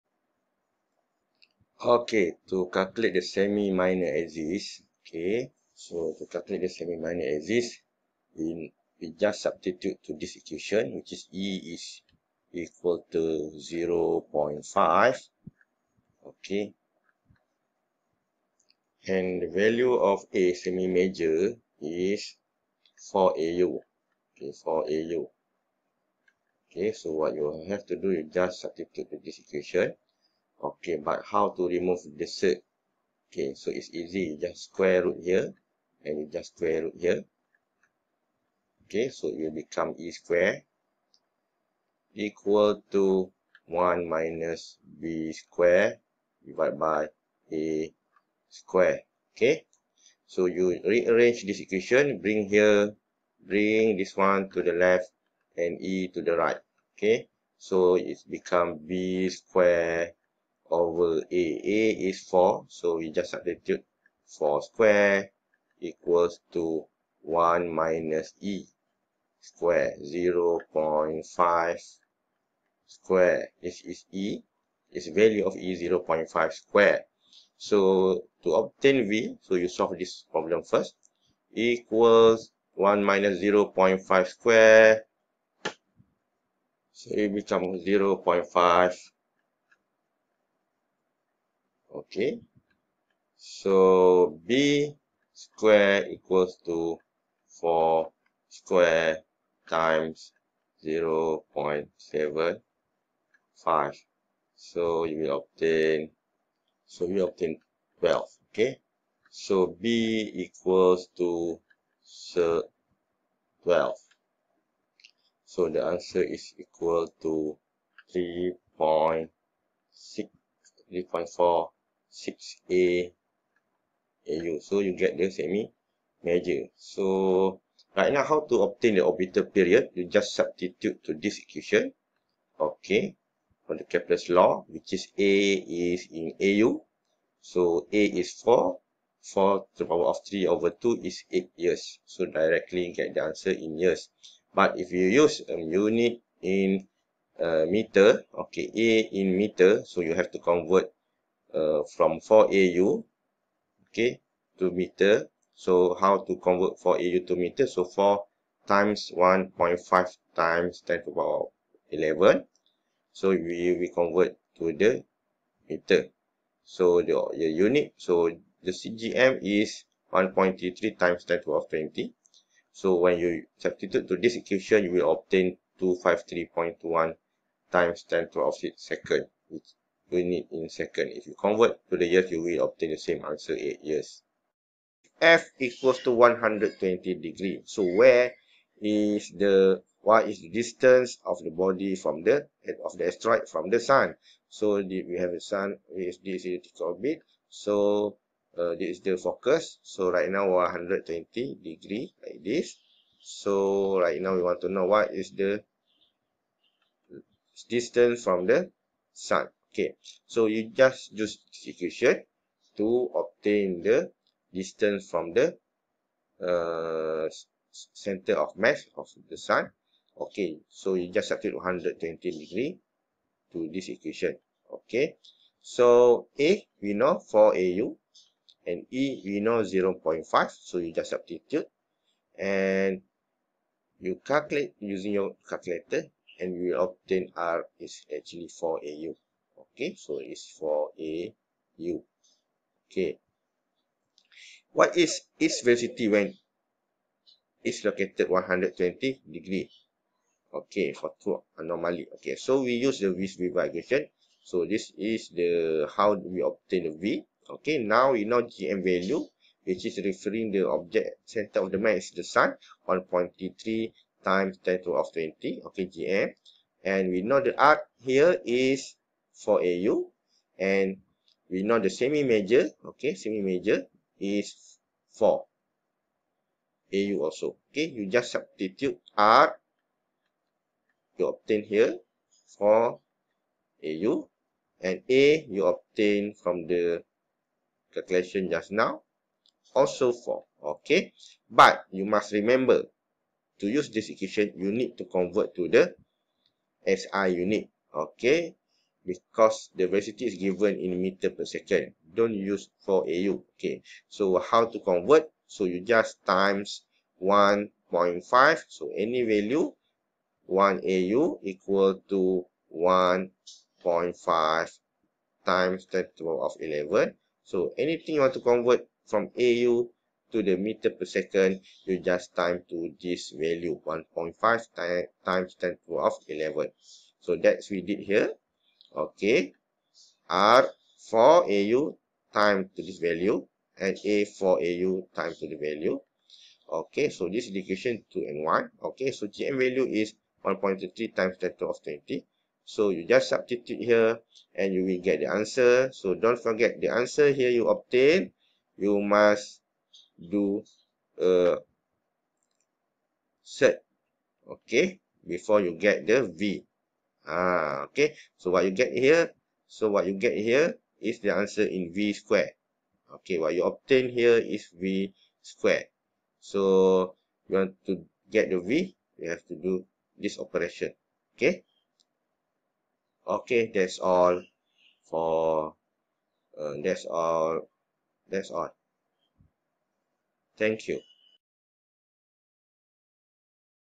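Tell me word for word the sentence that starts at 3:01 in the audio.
If you convert to the years, you will obtain the same answer, 8 years.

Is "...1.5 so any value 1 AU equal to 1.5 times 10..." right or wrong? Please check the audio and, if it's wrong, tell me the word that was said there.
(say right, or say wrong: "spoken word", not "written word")
right.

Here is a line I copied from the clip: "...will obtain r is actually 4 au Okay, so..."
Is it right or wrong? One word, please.
right.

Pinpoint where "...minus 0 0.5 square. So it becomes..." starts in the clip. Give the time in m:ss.
1:23.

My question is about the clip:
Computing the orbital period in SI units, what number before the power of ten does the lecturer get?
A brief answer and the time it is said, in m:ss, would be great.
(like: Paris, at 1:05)
253.21, at 2:55.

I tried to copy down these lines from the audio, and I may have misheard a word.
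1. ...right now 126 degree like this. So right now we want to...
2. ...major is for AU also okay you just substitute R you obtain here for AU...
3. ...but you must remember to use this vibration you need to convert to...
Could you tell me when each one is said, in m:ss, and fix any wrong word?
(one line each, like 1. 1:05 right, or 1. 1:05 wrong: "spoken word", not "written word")
1. 3:20 wrong: "120", not "126"
2. 4:33 right
3. 4:51 wrong: "equation", not "vibration".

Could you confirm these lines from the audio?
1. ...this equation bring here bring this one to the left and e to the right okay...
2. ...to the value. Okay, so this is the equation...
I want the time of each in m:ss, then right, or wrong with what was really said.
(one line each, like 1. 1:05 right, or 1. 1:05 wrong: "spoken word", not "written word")
1. 0:51 right
2. 5:35 right.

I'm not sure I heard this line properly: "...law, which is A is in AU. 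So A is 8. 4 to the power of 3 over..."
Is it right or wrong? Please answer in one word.
wrong.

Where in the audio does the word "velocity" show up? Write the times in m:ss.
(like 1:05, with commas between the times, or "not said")
4:05, 4:59.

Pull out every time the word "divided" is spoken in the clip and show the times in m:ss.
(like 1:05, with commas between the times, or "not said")
0:46.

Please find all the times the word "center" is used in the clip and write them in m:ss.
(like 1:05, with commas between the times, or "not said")
3:37, 4:21.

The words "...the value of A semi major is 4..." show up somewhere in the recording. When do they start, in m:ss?
0:19.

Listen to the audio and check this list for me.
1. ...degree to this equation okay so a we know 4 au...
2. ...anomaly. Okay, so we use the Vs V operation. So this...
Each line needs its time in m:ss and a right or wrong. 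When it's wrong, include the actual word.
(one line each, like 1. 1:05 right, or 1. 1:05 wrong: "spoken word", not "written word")
1. 3:42 right
2. 4:11 wrong: "vibration", not "operation".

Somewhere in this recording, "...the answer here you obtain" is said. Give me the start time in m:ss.
5:46.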